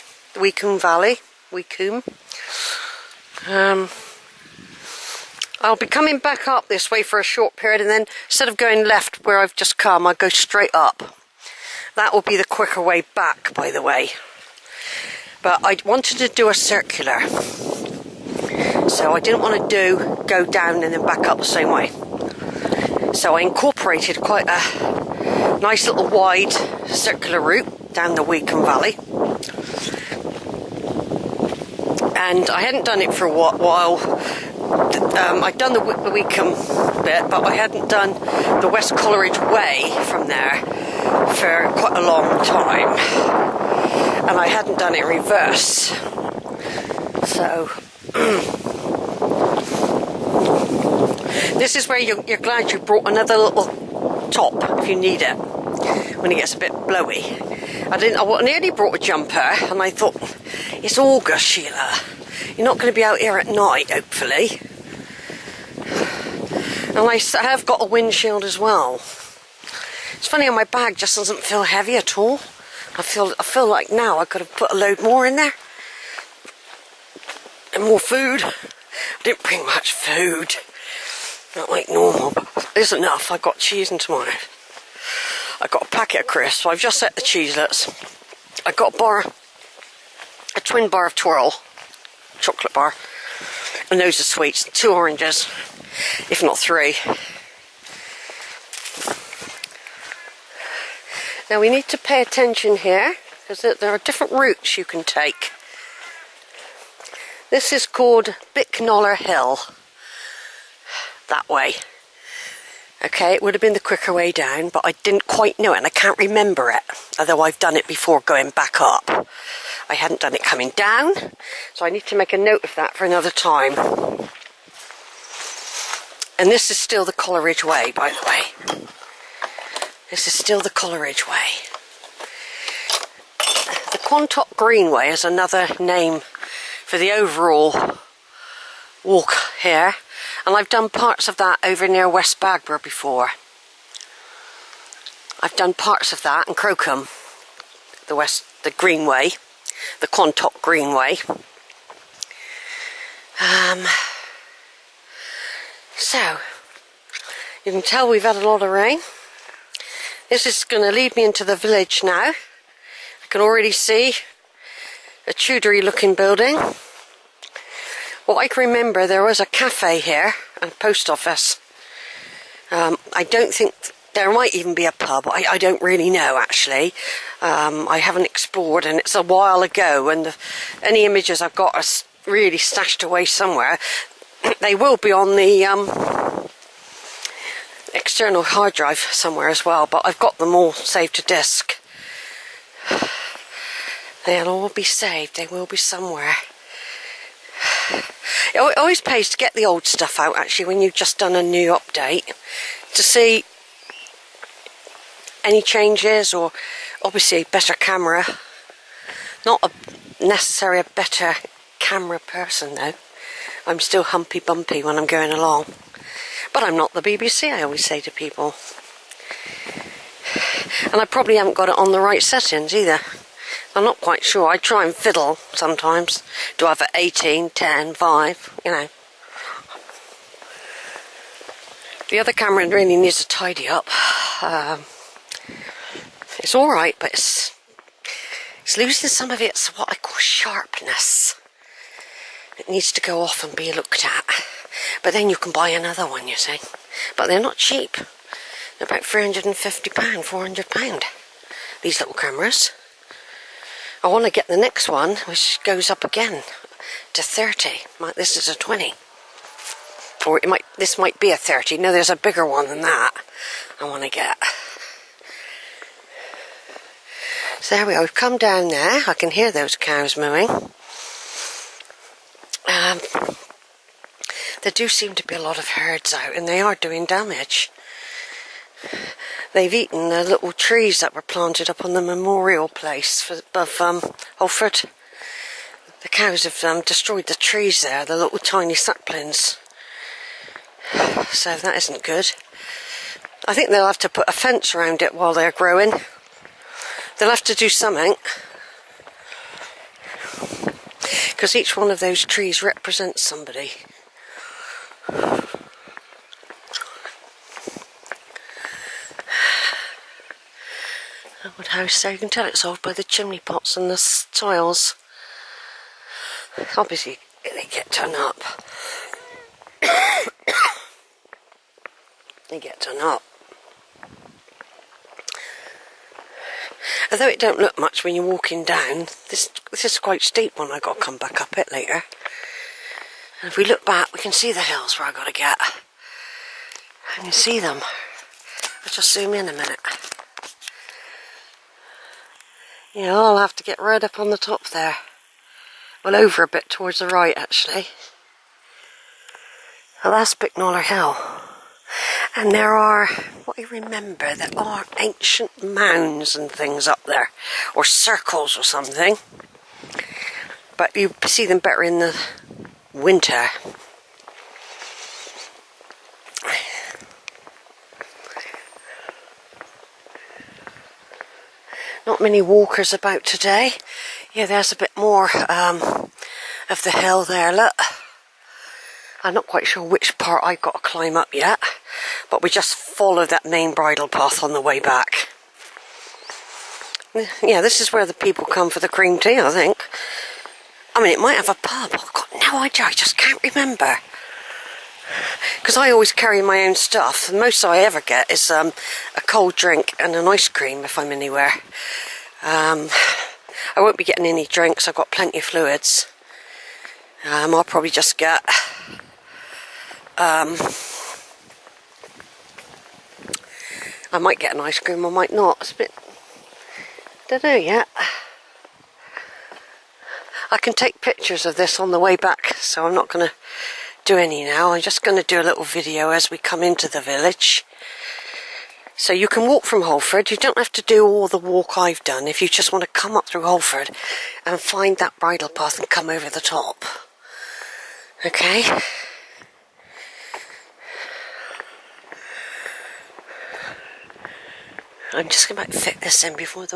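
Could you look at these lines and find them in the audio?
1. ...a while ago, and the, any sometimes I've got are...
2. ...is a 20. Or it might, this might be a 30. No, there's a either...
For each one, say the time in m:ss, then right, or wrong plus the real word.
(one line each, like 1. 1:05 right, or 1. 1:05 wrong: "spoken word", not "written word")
1. 2:59 wrong: "images", not "sometimes"
2. 4:18 wrong: "bigger", not "either".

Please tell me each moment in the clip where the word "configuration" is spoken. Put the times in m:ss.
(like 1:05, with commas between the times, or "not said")
not said.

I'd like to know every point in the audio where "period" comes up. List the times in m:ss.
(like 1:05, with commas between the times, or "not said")
0:07.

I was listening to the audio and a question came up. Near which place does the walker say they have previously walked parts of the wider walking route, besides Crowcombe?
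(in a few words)
West Bagborough.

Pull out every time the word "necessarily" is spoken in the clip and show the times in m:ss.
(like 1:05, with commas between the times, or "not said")
3:30.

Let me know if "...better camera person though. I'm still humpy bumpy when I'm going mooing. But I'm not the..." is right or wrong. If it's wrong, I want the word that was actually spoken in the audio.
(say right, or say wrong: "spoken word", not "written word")
wrong: "along", not "mooing".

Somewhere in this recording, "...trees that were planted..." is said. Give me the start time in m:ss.
4:40.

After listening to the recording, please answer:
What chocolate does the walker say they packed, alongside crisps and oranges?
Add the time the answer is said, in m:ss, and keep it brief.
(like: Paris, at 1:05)
Twirl, at 1:31.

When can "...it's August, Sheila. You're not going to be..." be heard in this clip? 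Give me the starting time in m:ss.
1:00.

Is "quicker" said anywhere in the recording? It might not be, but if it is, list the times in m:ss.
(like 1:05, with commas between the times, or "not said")
0:12, 1:53.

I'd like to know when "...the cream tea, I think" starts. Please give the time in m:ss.
6:28.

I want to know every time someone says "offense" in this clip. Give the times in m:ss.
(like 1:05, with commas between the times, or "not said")
not said.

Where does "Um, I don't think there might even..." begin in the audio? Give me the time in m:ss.
2:52.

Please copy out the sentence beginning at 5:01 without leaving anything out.
Because each one of those trees represents somebody.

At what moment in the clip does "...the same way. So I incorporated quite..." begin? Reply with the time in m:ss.
0:21.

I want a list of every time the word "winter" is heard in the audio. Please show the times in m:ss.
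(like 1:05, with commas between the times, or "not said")
6:02.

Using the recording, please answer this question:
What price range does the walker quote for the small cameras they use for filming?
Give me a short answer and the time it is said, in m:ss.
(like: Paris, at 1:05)
£350 to £400, at 4:09.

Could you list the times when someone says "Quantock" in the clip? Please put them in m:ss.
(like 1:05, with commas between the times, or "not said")
2:13, 2:30.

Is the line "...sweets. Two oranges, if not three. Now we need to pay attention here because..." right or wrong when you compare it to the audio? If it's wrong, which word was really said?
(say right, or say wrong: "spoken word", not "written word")
right.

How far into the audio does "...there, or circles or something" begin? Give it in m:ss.
5:57.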